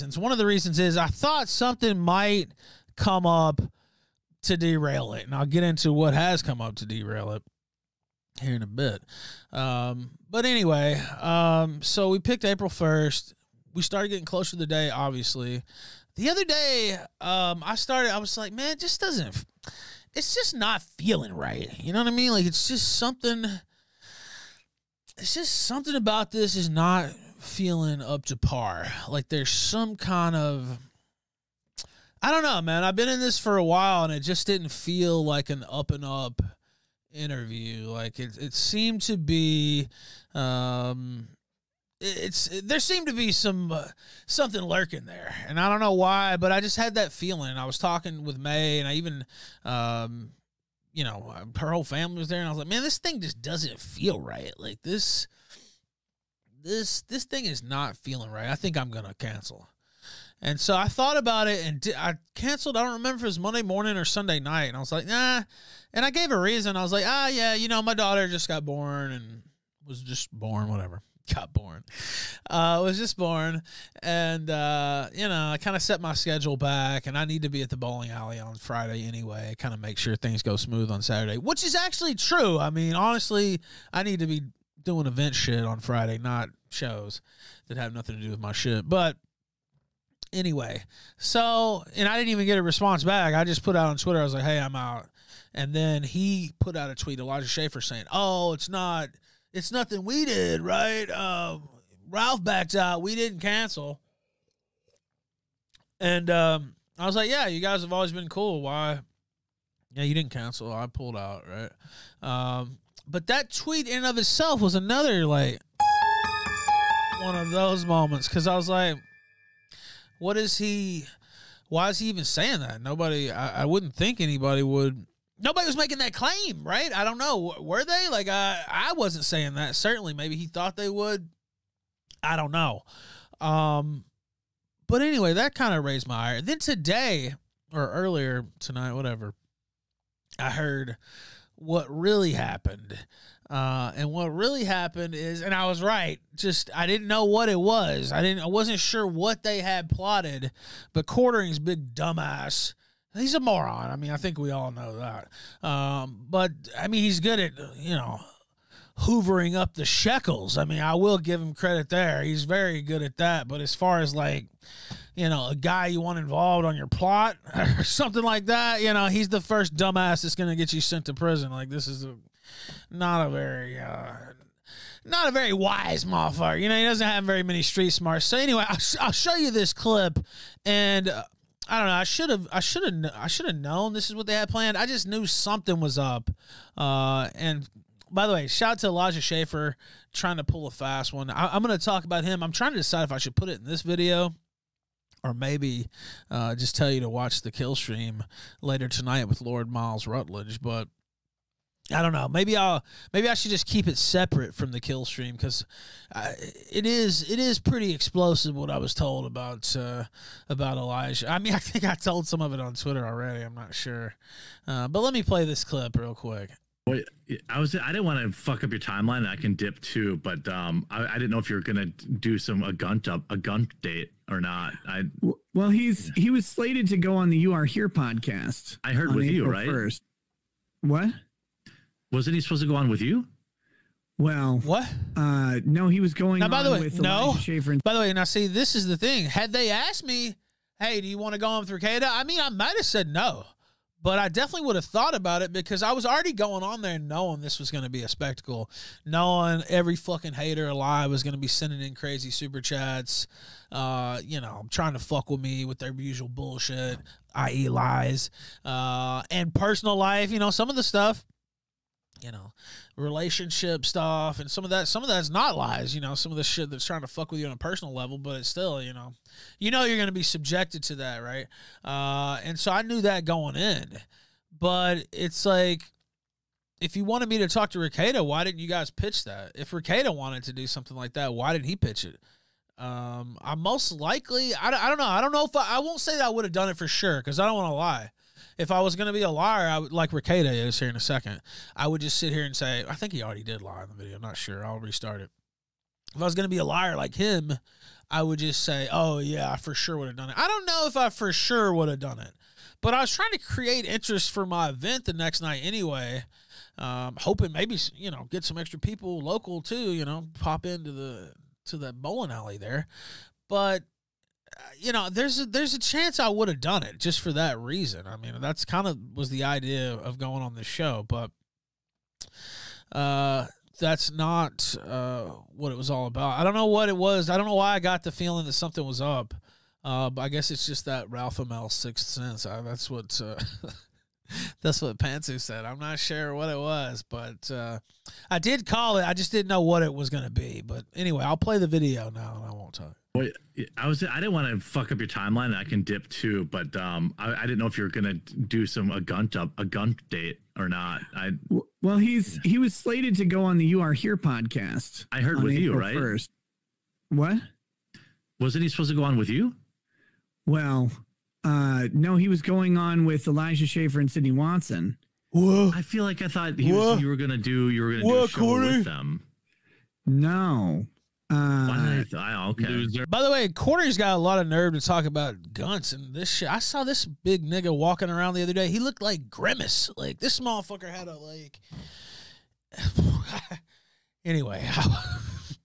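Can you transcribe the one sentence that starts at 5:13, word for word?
But you know, there's a, there's a chance I would have done it just for that reason.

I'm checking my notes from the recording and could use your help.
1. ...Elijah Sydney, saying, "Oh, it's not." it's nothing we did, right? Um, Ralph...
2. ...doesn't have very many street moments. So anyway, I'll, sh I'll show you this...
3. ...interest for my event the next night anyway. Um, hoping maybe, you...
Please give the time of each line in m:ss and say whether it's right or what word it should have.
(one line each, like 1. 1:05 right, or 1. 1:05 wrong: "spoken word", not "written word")
1. 1:37 wrong: "Schaffer", not "Sydney"
2. 2:56 wrong: "smarts", not "moments"
3. 5:03 right.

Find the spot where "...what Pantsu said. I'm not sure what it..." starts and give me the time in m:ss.
5:34.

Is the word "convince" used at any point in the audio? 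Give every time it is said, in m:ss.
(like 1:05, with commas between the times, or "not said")
not said.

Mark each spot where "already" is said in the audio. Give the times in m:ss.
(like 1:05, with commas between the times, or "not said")
3:33, 4:06, 4:53.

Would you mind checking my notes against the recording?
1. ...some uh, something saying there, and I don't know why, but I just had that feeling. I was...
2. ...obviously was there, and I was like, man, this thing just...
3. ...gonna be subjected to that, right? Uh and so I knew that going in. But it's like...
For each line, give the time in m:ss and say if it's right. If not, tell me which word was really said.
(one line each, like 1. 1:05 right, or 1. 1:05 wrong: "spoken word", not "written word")
1. 0:43 wrong: "lurking", not "saying"
2. 0:51 wrong: "family", not "obviously"
3. 4:29 right.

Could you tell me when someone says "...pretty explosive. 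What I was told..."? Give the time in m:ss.
3:27.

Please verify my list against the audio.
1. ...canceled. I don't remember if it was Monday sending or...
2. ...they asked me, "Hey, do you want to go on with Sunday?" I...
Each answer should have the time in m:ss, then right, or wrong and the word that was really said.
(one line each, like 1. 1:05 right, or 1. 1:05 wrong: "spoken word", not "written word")
1. 1:02 wrong: "morning", not "sending"
2. 3:59 wrong: "Rekieta", not "Sunday".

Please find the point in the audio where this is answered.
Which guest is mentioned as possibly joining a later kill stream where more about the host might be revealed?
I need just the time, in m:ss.
3:19.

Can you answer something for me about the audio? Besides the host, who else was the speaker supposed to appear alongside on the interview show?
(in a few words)
Sydney Watson.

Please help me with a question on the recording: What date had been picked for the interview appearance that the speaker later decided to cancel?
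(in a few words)
April 1.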